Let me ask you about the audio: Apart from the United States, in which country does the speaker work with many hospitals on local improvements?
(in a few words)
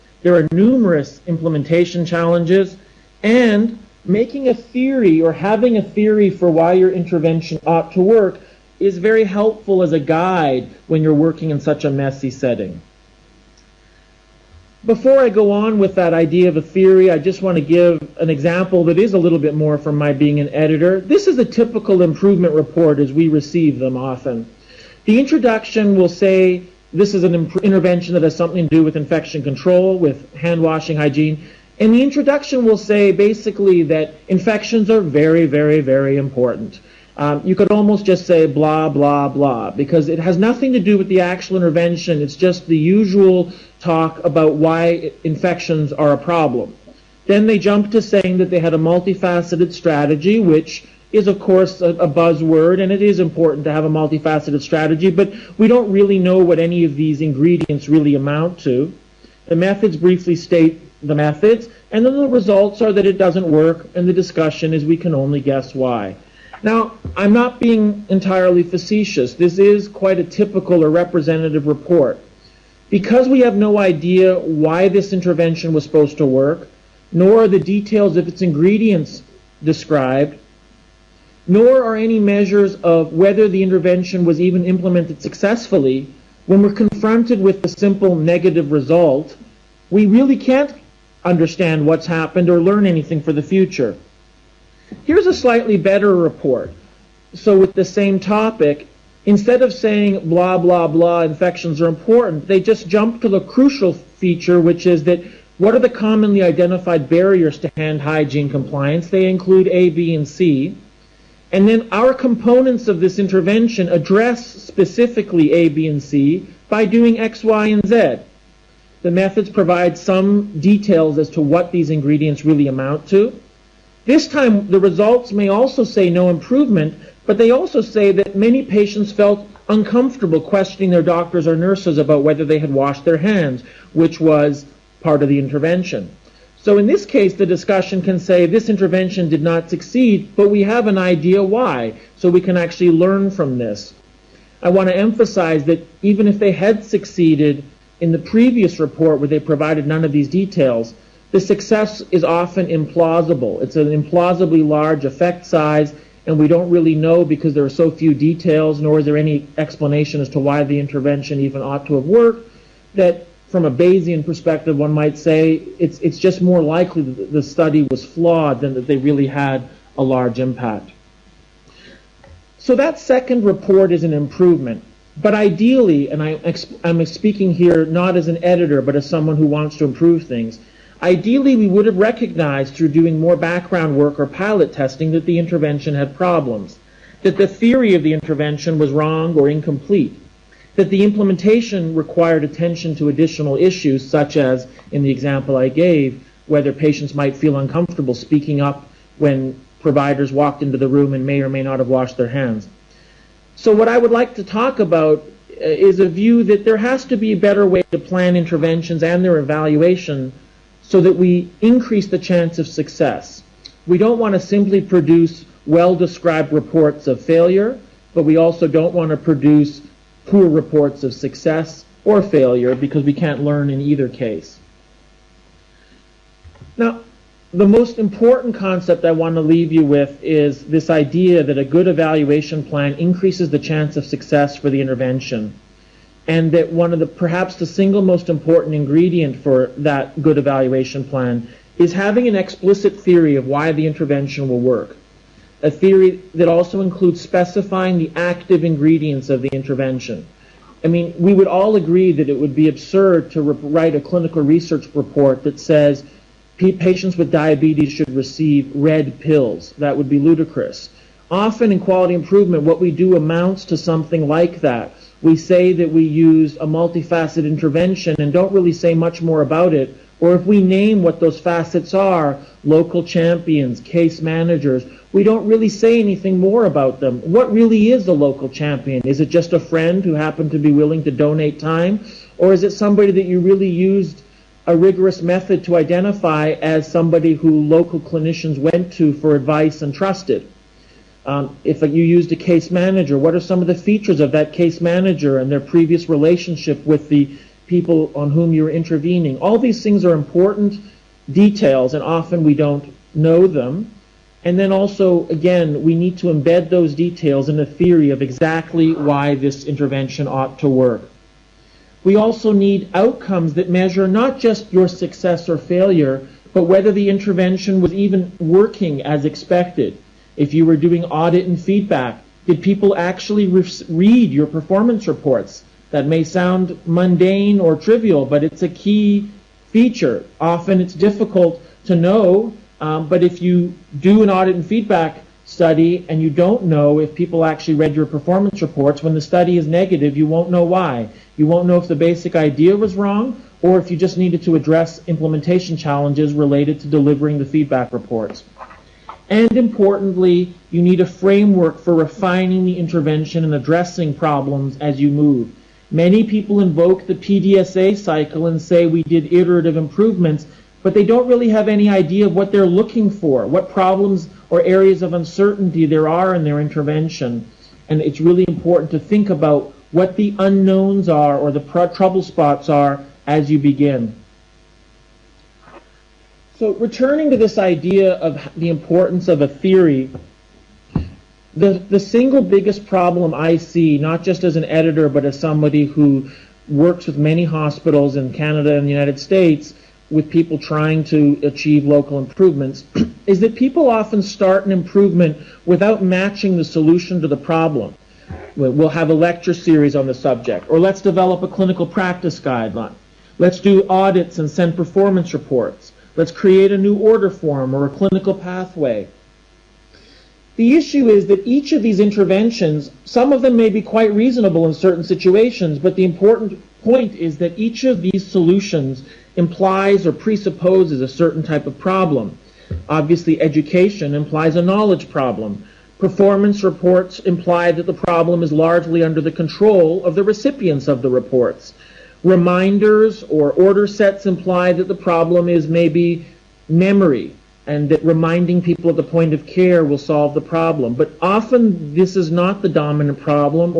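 Canada.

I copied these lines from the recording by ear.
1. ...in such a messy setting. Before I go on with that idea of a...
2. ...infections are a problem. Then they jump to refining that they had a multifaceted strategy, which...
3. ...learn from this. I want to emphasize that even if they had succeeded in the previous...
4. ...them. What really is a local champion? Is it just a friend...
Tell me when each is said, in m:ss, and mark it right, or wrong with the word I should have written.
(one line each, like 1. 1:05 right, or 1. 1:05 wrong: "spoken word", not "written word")
1. 0:11 right
2. 0:45 wrong: "saying", not "refining"
3. 2:22 right
4. 4:36 right.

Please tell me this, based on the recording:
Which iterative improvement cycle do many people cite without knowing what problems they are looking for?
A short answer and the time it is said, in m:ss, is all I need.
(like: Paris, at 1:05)
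PDSA cycle, at 5:57.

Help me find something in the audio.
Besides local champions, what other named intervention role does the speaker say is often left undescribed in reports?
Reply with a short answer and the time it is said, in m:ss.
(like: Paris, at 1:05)
Case managers, at 4:33.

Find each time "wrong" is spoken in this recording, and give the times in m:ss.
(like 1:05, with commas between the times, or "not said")
3:08, 5:42.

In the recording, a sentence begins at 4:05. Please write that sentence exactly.
A theory that also includes specifying the active ingredients of the intervention.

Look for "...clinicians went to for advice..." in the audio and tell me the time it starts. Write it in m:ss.
4:47.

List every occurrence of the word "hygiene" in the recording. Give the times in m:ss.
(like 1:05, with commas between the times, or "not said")
0:30, 1:47.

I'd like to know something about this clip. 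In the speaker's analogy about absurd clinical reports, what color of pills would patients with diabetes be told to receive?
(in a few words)
Red.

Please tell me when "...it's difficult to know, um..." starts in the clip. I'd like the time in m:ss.
5:30.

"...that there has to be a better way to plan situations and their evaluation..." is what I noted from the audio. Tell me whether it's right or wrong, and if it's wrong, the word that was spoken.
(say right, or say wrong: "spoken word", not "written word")
wrong: "interventions", not "situations".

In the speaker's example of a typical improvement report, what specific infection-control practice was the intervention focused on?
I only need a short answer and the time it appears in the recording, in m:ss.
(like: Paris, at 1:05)
Hand washing, at 0:30.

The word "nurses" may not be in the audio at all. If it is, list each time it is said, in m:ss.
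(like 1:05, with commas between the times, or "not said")
2:11.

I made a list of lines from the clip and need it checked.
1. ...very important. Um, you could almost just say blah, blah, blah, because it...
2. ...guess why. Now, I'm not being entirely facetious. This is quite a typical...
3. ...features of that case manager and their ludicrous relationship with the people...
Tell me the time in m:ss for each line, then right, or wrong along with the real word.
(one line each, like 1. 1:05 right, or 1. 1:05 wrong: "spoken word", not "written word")
1. 0:35 right
2. 1:05 right
3. 4:53 wrong: "previous", not "ludicrous".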